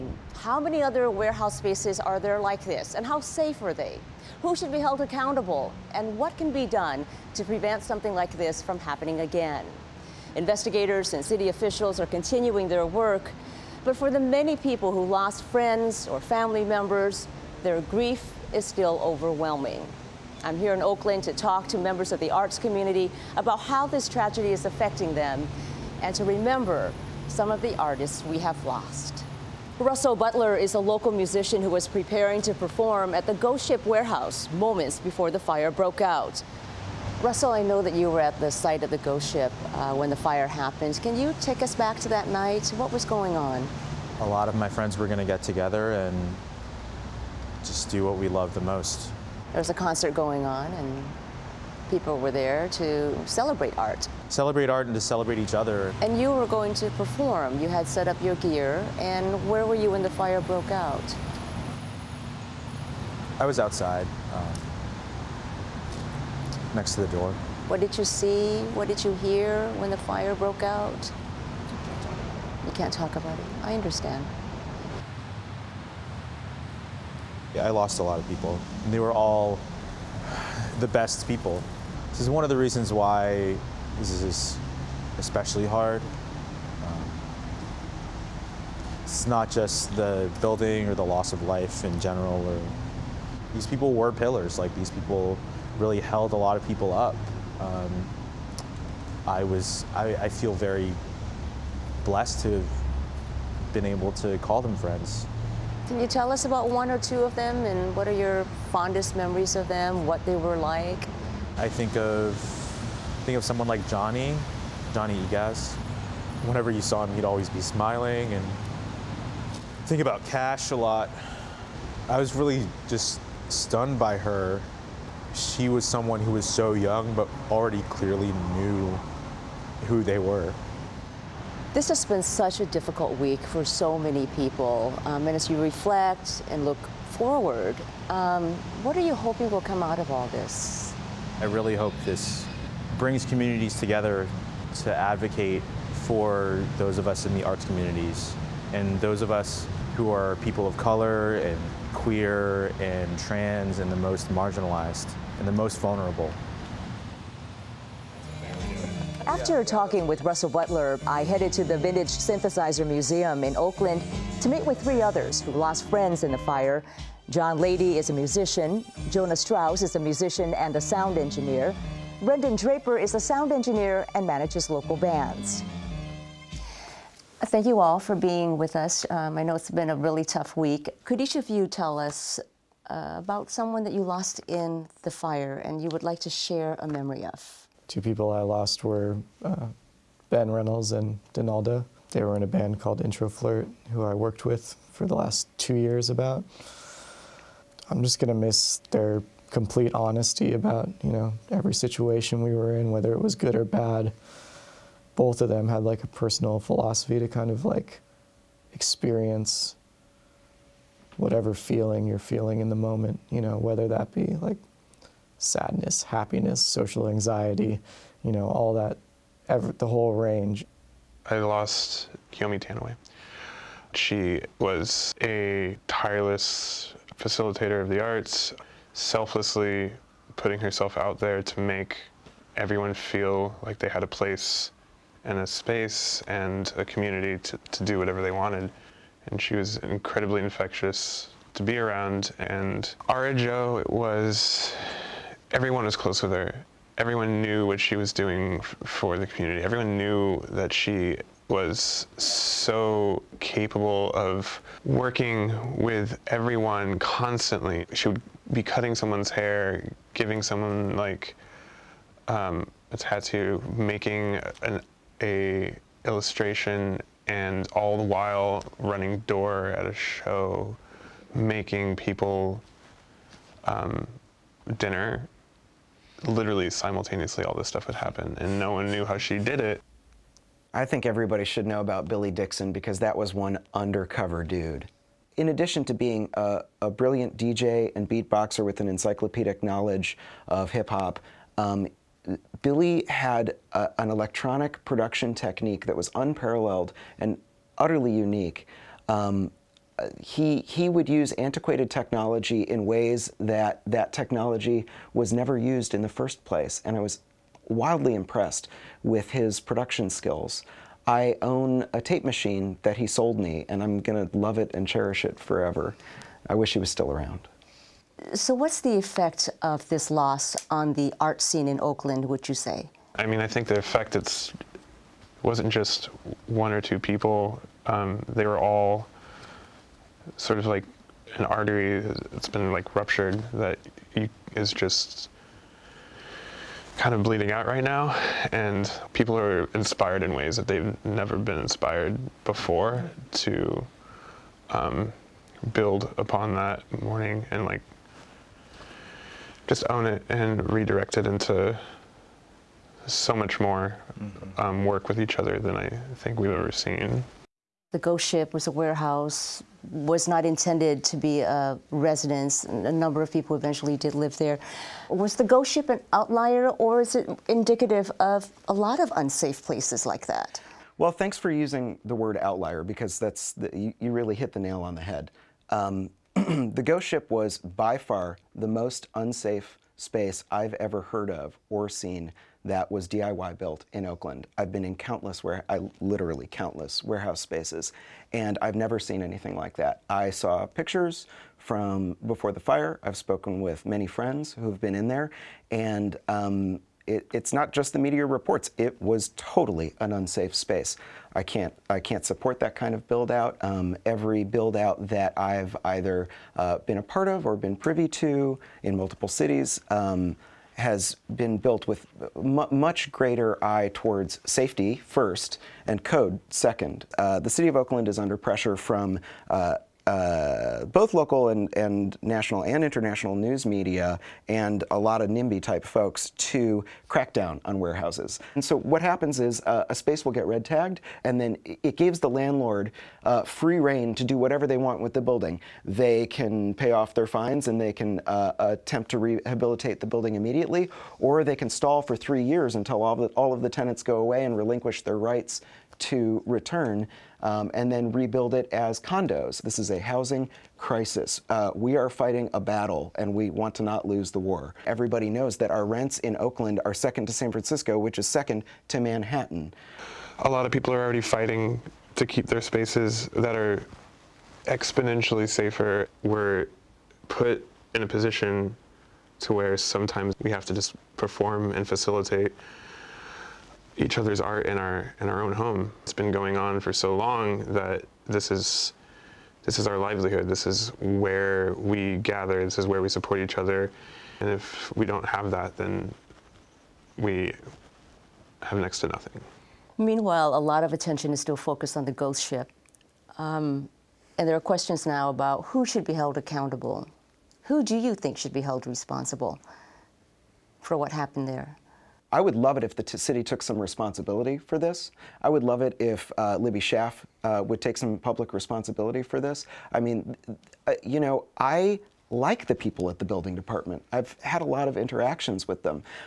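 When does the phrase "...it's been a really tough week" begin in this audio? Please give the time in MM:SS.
02:59.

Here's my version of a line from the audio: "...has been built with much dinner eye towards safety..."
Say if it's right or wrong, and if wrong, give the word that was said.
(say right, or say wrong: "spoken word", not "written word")
wrong: "greater", not "dinner".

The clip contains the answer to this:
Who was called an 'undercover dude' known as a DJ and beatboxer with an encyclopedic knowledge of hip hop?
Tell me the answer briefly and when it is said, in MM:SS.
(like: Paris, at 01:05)
Billy Dixon, at 04:42.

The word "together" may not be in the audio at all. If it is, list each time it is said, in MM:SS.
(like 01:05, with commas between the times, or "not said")
00:45, 02:23.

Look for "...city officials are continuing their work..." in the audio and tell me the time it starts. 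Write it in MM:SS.
00:11.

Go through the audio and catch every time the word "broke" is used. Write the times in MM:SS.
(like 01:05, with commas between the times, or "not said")
00:35, 01:00, 01:10.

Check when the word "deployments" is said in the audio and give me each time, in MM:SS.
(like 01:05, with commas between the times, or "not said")
not said.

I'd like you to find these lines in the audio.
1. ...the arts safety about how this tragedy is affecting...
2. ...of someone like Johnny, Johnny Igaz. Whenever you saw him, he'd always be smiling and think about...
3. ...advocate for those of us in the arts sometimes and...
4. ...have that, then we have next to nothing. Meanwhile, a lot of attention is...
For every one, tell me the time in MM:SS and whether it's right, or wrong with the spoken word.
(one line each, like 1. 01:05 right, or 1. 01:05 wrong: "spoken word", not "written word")
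1. 00:22 wrong: "community", not "safety"
2. 01:53 right
3. 02:24 wrong: "communities", not "sometimes"
4. 08:05 right.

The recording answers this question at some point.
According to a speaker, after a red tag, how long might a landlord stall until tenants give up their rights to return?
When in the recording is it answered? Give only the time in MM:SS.
07:22.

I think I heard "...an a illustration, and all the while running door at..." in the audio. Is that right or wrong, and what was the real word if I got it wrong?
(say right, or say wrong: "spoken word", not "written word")
right.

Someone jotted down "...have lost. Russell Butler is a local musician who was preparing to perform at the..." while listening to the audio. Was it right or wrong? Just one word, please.
right.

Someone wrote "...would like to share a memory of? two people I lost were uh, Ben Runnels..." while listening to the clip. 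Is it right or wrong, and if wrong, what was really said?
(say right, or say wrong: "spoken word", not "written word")
right.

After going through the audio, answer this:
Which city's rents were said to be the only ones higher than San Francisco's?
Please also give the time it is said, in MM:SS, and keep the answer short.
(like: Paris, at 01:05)
Manhattan, at 07:38.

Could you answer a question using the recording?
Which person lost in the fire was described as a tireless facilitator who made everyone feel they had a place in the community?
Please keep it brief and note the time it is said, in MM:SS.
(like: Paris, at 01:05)
Kiyomi Tanouye, at 03:42.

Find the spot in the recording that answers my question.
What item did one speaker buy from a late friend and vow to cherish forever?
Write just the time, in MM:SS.
05:12.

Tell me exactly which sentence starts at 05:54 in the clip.
um, work with each other than I think we've ever seen.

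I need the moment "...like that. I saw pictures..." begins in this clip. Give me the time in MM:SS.
06:29.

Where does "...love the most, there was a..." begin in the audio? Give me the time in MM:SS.
00:48.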